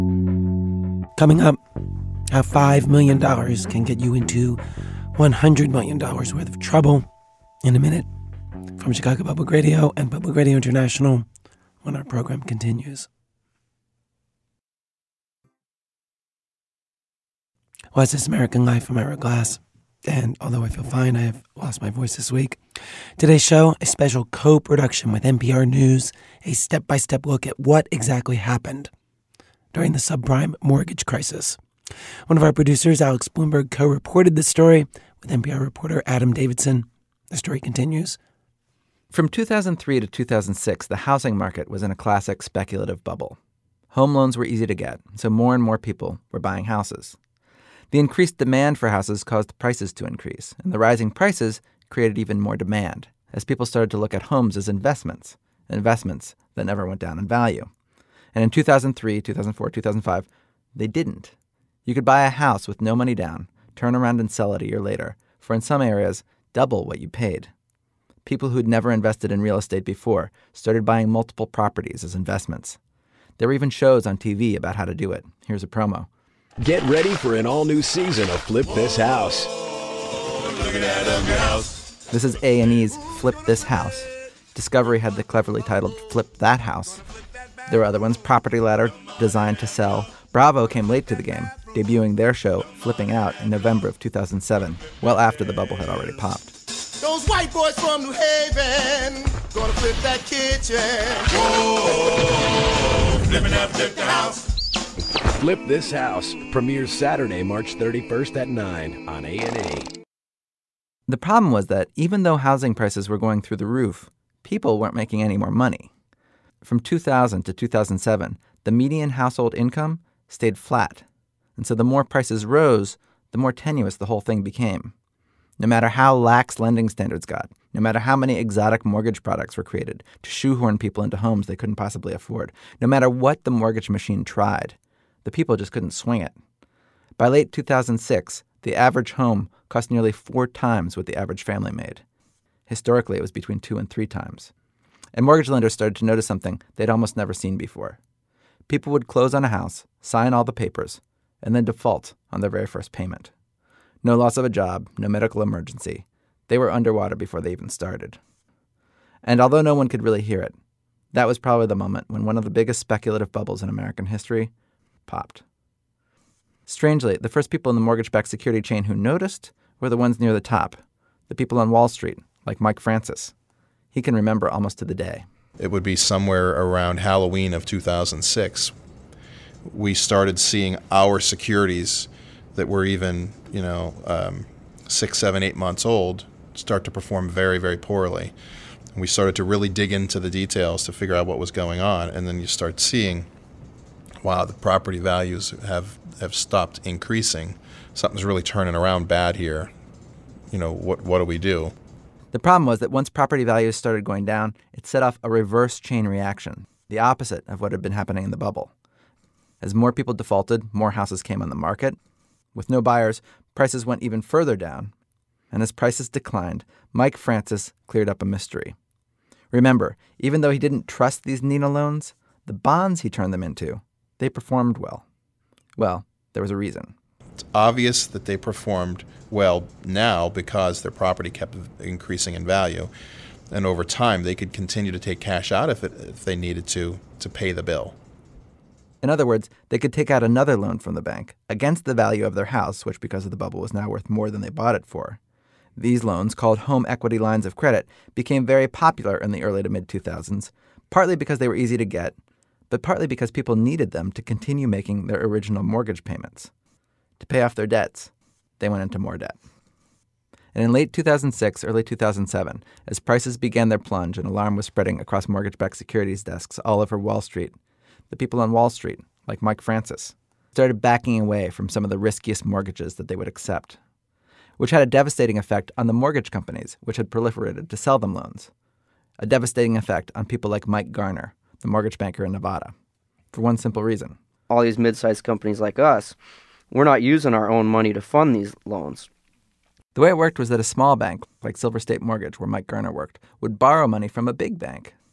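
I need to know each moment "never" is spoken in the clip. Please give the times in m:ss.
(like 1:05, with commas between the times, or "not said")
0:56, 1:08, 2:27.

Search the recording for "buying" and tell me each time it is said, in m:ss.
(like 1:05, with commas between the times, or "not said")
0:46, 1:10.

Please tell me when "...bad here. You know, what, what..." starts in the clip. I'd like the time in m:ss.
3:19.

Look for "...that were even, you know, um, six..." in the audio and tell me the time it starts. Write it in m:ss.
3:02.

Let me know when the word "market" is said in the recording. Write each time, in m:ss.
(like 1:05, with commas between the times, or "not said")
0:41, 3:31.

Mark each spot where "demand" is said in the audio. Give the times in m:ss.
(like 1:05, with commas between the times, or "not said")
0:48, 0:52.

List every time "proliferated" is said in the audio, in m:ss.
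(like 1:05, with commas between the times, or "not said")
4:37.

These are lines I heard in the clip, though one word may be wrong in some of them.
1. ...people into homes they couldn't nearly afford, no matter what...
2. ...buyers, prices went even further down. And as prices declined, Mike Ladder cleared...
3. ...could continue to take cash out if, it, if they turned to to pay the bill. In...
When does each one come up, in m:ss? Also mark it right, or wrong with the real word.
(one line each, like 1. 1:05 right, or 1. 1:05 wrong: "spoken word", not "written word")
1. 2:10 wrong: "possibly", not "nearly"
2. 3:32 wrong: "Francis", not "Ladder"
3. 3:54 wrong: "needed", not "turned".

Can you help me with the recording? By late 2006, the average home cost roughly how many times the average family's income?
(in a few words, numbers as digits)
4.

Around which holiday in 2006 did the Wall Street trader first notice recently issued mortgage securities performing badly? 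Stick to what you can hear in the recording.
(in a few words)
Halloween.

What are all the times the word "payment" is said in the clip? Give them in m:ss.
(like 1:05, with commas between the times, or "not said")
2:32, 4:16.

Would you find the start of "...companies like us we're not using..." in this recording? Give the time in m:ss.
4:45.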